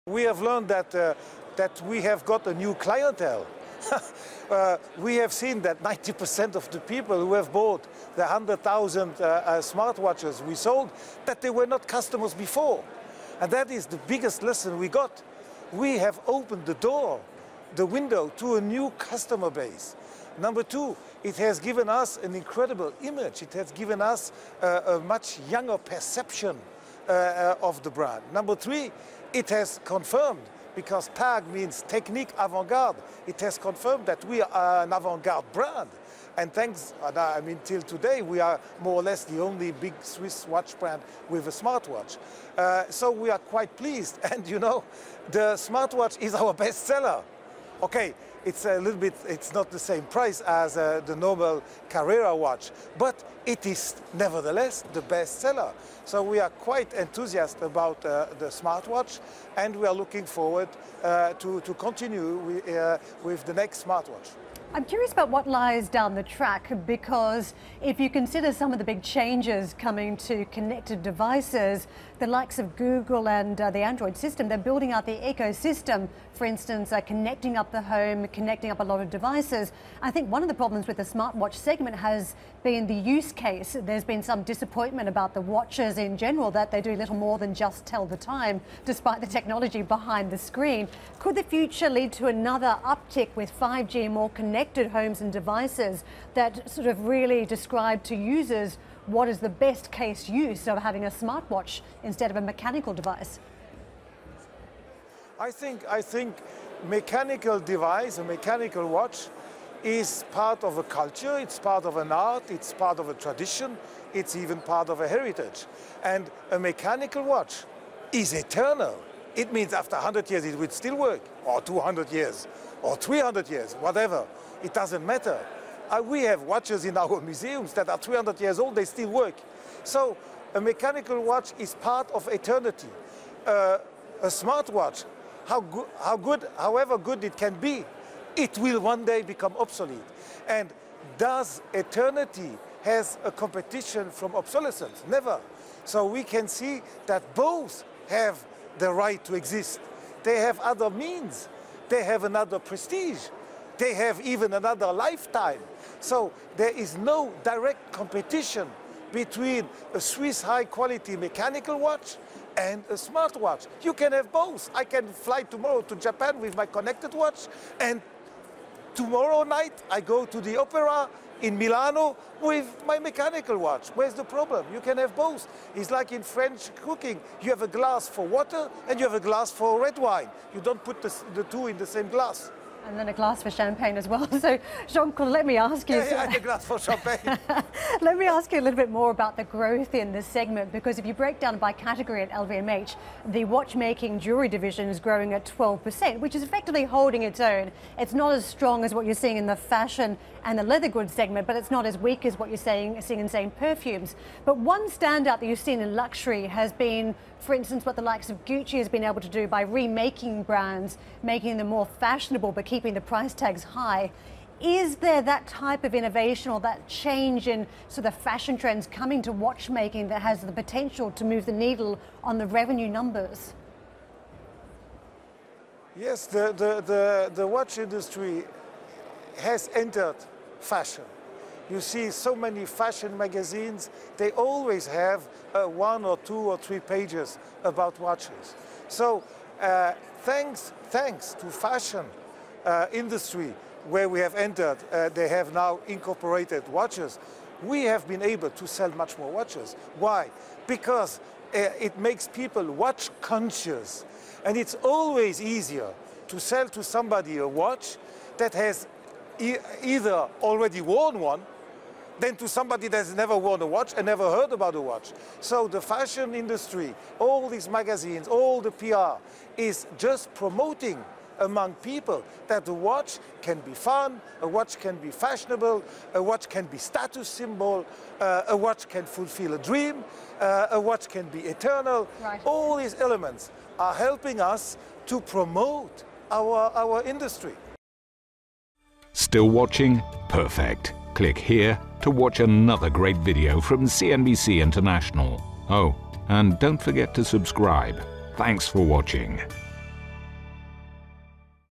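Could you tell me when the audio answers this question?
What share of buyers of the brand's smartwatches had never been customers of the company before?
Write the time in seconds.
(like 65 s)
5 s.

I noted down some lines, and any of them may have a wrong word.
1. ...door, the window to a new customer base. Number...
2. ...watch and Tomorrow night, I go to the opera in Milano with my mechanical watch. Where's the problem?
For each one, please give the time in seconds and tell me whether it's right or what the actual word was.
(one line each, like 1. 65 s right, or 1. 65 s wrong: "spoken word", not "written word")
1. 16 s right
2. 167 s right.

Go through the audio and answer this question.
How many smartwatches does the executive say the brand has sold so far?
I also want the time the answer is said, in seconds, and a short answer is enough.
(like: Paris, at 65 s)
100,000, at 8 s.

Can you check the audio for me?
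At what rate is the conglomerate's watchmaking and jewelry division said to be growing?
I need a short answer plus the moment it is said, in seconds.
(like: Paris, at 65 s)
12%, at 195 s.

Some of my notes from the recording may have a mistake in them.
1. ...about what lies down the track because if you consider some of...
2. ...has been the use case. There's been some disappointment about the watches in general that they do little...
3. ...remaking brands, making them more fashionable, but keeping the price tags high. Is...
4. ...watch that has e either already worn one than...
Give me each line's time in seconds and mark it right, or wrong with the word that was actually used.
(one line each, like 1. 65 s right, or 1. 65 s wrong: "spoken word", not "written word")
1. 65 s right
2. 81 s right
3. 209 s right
4. 257 s right.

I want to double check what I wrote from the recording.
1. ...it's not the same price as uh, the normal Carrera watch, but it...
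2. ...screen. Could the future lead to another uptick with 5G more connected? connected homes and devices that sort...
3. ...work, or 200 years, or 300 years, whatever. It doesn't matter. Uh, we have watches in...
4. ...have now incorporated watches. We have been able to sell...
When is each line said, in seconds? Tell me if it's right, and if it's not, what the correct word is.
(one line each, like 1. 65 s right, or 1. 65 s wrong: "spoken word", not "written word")
1. 49 s right
2. 90 s right
3. 120 s right
4. 245 s right.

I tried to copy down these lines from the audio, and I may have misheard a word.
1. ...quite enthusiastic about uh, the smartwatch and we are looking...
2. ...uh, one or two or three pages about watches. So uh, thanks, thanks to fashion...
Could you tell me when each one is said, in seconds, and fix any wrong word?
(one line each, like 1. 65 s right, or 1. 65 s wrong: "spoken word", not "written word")
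1. 56 s right
2. 235 s right.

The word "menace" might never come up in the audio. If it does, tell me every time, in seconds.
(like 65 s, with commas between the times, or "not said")
not said.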